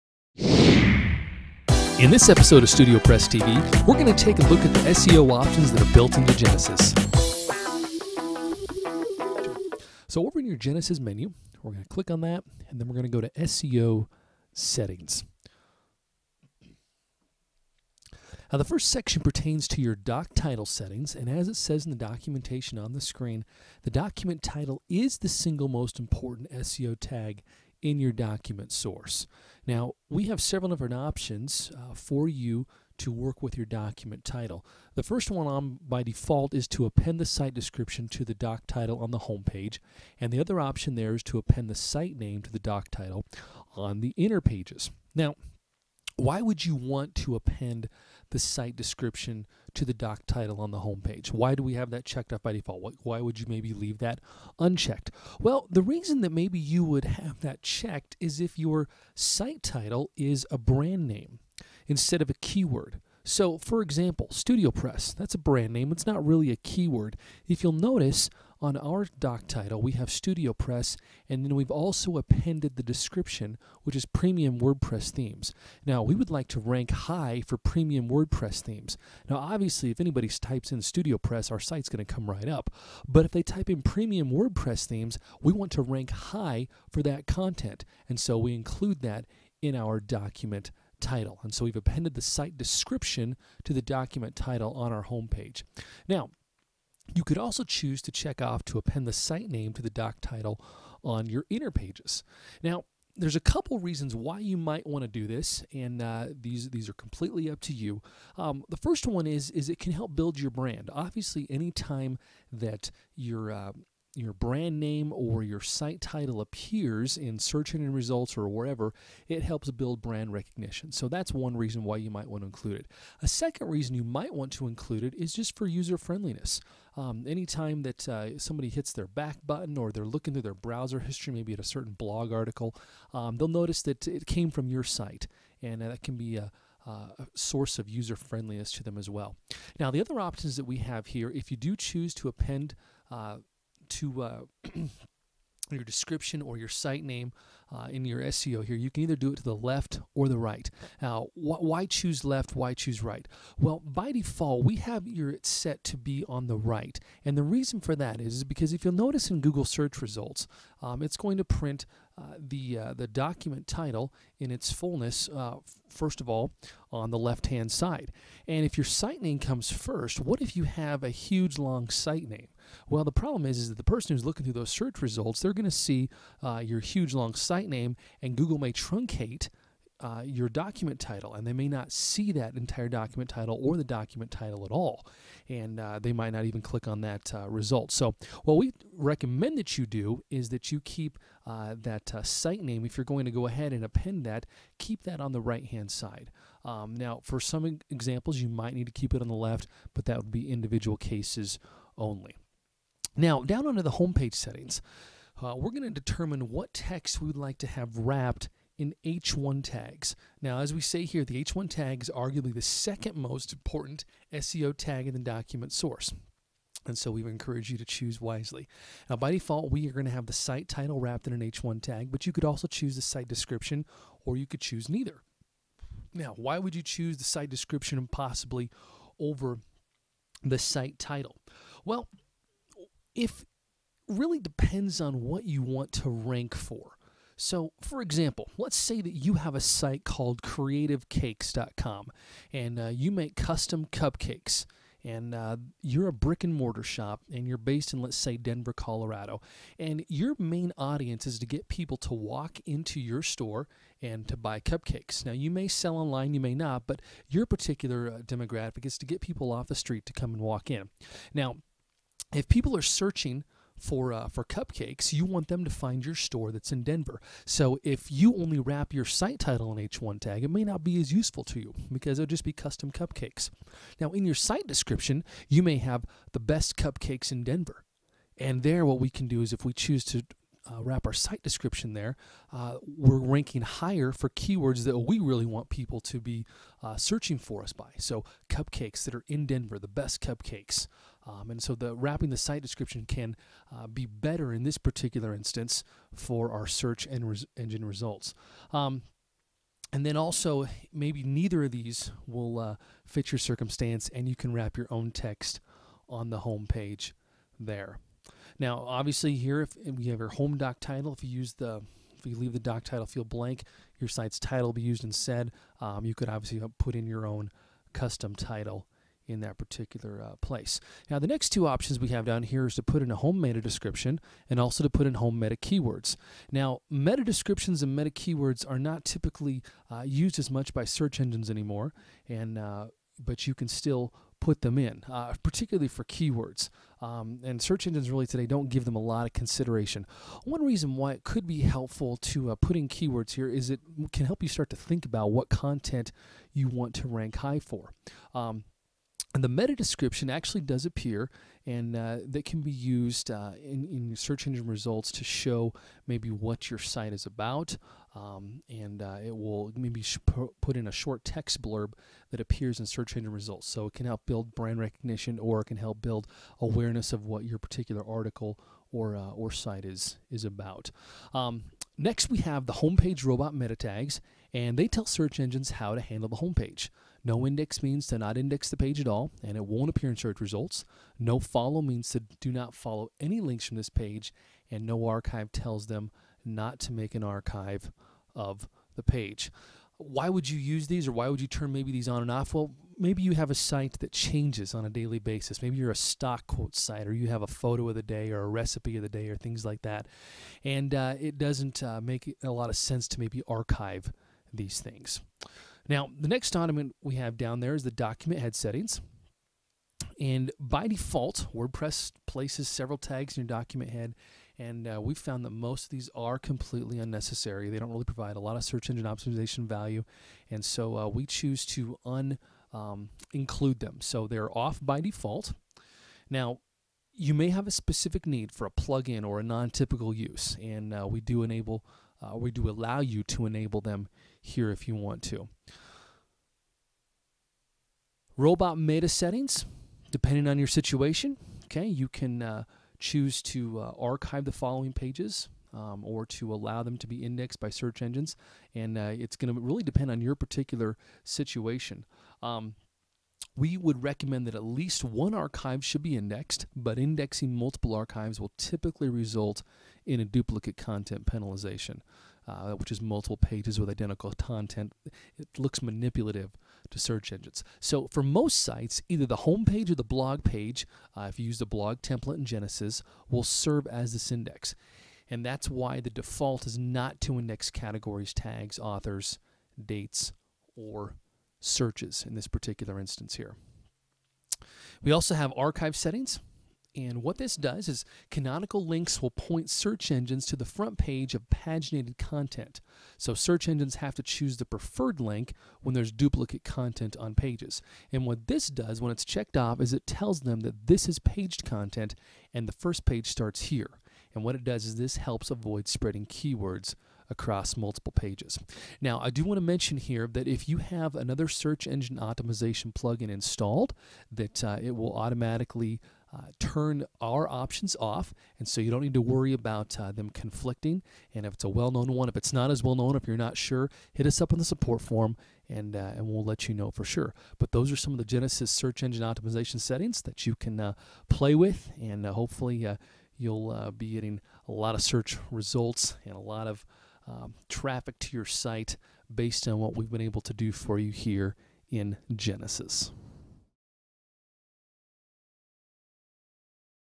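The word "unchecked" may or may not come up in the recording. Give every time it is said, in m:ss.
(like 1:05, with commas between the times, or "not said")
0:54.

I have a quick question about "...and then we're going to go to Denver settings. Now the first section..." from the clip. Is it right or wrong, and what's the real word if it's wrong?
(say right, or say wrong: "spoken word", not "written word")
wrong: "SEO", not "Denver".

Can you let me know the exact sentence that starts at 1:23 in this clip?
But if they type in premium WordPress themes, we want to rank high for that content.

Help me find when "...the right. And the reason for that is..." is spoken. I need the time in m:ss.
2:36.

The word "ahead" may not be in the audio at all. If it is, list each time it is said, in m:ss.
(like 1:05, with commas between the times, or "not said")
3:13.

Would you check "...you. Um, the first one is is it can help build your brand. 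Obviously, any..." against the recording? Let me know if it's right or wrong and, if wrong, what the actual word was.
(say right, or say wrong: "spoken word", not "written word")
right.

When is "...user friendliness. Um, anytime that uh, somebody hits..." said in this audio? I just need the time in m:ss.
2:05.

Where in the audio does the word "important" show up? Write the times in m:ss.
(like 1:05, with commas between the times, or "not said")
0:25, 3:33.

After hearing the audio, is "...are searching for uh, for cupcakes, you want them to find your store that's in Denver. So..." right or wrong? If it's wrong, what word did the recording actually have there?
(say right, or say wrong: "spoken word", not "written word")
right.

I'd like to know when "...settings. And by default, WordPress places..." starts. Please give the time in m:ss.
6:48.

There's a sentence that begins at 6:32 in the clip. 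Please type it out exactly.
Well, maybe you have a site that changes on a daily basis.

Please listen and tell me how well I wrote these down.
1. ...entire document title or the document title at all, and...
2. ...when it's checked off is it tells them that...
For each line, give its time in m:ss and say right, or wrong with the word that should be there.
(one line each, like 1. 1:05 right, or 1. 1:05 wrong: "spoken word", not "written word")
1. 3:02 right
2. 8:18 right.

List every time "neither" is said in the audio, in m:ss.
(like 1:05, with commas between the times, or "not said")
3:44, 5:01.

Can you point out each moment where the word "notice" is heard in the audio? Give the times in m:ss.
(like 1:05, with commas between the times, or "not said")
1:07, 2:13, 2:38.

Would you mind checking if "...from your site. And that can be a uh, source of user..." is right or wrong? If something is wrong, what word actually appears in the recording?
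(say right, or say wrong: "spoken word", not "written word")
right.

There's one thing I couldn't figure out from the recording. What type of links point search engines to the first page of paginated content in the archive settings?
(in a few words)
canonical links.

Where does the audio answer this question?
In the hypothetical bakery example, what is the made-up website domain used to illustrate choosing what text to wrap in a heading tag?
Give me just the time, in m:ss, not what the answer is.
4:00.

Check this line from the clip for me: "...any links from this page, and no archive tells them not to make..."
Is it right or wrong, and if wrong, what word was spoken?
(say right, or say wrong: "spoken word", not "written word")
right.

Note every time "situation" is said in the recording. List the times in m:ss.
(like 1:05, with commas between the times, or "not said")
7:20, 7:31.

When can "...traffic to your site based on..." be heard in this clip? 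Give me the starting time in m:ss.
8:57.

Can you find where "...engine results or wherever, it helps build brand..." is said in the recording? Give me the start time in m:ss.
1:57.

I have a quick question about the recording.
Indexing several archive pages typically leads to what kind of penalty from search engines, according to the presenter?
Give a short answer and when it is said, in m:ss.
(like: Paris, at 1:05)
duplicate content penalization, at 7:40.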